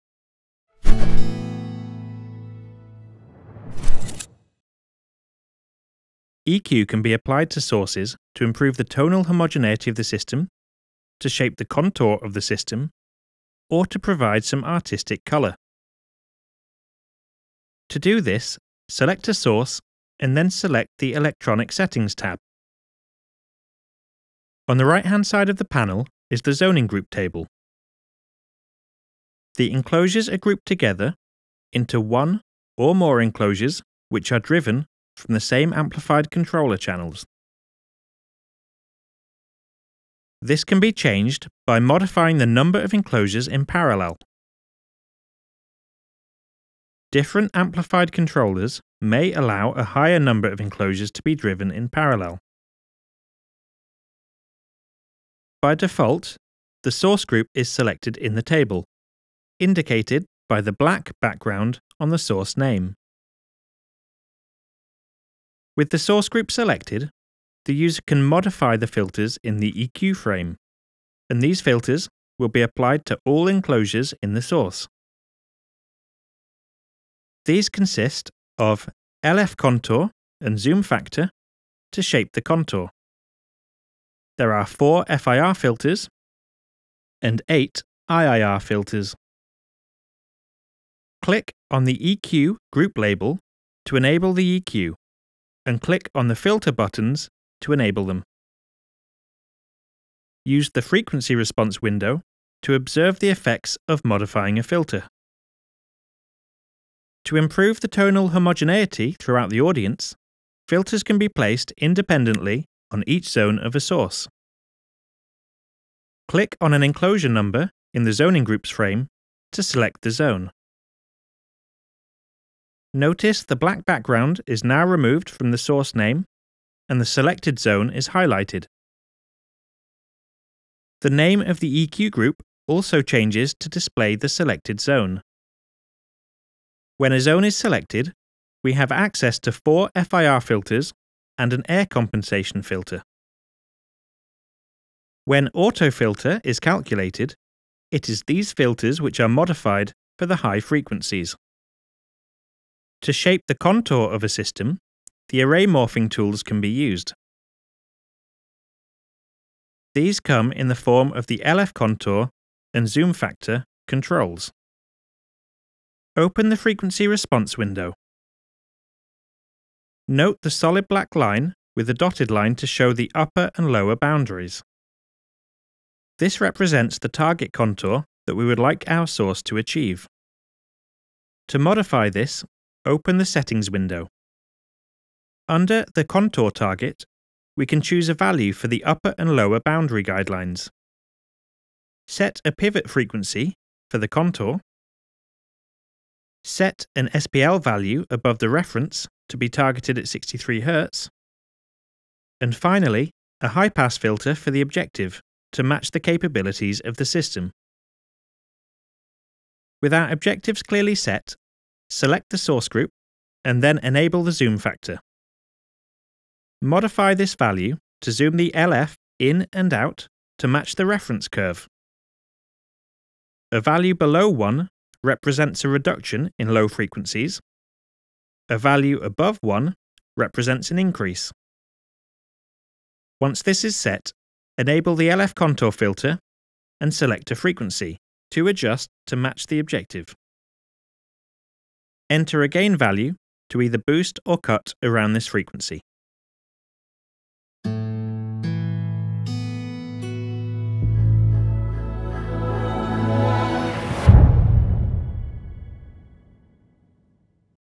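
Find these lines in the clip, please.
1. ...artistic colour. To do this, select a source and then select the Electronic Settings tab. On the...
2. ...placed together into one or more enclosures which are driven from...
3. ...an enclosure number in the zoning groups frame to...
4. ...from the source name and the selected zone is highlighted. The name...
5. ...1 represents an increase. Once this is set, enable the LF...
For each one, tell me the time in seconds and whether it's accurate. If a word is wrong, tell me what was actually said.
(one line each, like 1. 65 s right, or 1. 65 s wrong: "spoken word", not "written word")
1. 14 s right
2. 30 s wrong: "grouped", not "placed"
3. 116 s right
4. 125 s right
5. 229 s right.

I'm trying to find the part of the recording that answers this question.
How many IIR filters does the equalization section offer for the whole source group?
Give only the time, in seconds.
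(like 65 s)
87 s.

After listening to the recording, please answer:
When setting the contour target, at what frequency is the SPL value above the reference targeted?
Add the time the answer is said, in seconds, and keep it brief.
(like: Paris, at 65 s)
63 Hz, at 200 s.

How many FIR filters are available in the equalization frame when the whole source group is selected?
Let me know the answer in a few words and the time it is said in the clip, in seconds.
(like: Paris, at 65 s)
4, at 84 s.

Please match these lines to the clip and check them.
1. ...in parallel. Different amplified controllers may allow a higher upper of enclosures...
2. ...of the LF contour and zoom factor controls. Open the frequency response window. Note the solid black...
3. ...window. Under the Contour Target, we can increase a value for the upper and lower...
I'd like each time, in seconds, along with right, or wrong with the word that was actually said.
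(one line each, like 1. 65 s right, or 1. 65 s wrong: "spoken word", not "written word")
1. 43 s wrong: "number", not "upper"
2. 161 s right
3. 183 s wrong: "choose", not "increase".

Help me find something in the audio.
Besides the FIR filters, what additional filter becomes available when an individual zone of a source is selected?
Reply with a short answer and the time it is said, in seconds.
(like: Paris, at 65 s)
air compensation filter, at 141 s.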